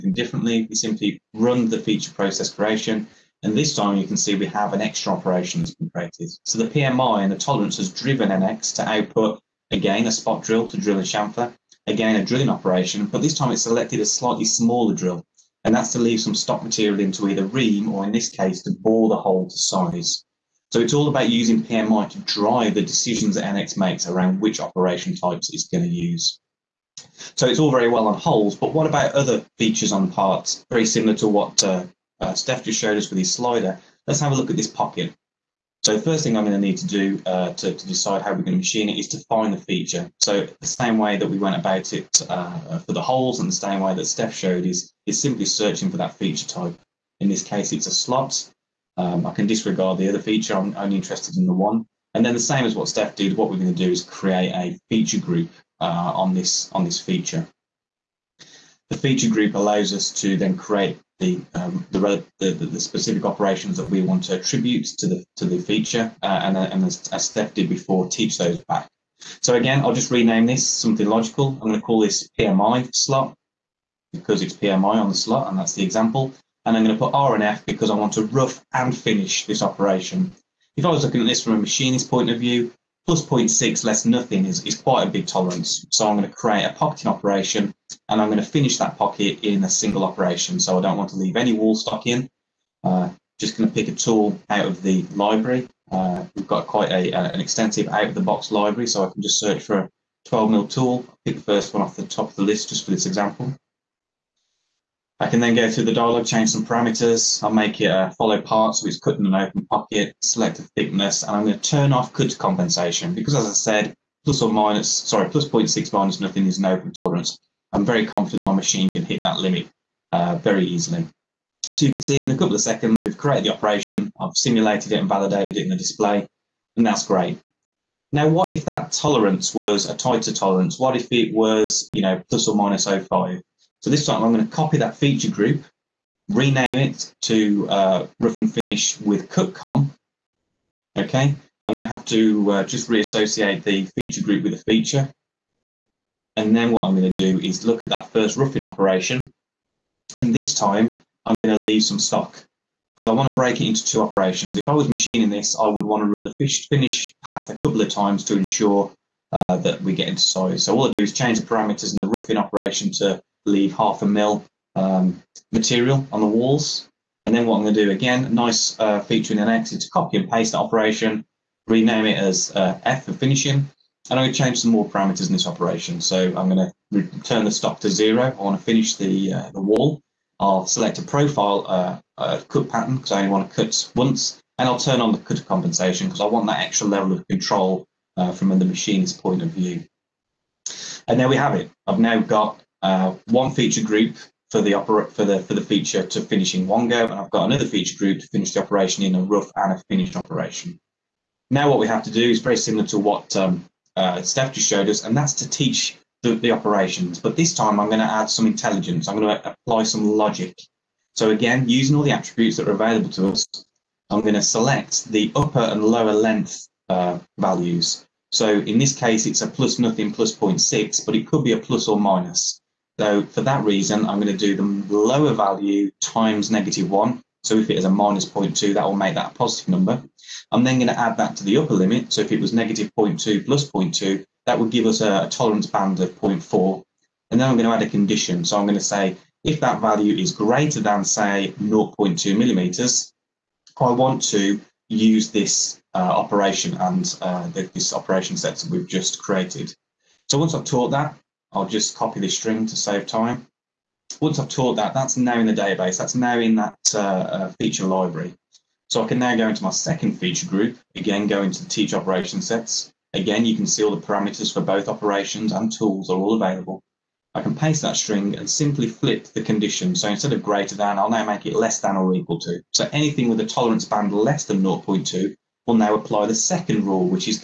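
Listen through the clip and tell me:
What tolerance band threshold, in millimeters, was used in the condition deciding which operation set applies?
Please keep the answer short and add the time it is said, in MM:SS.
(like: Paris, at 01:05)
0.2 mm, at 04:01.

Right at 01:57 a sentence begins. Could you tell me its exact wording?
I'm very confident my machine can hit that limit uh, very easily.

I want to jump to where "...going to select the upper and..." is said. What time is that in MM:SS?
03:34.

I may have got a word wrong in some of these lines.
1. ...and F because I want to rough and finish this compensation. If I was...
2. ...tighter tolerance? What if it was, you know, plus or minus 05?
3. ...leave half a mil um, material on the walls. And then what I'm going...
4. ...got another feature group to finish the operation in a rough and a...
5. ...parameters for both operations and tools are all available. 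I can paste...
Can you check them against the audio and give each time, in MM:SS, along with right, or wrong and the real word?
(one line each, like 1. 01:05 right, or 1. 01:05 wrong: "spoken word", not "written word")
1. 01:17 wrong: "operation", not "compensation"
2. 02:09 right
3. 02:43 right
4. 03:17 right
5. 04:24 right.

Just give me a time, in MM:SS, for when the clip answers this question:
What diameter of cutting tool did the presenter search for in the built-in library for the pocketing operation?
01:40.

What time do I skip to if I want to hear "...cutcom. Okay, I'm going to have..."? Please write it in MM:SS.
02:19.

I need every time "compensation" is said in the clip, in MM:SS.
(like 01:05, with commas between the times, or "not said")
01:52, 03:05.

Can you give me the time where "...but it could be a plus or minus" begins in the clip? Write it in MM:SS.
03:41.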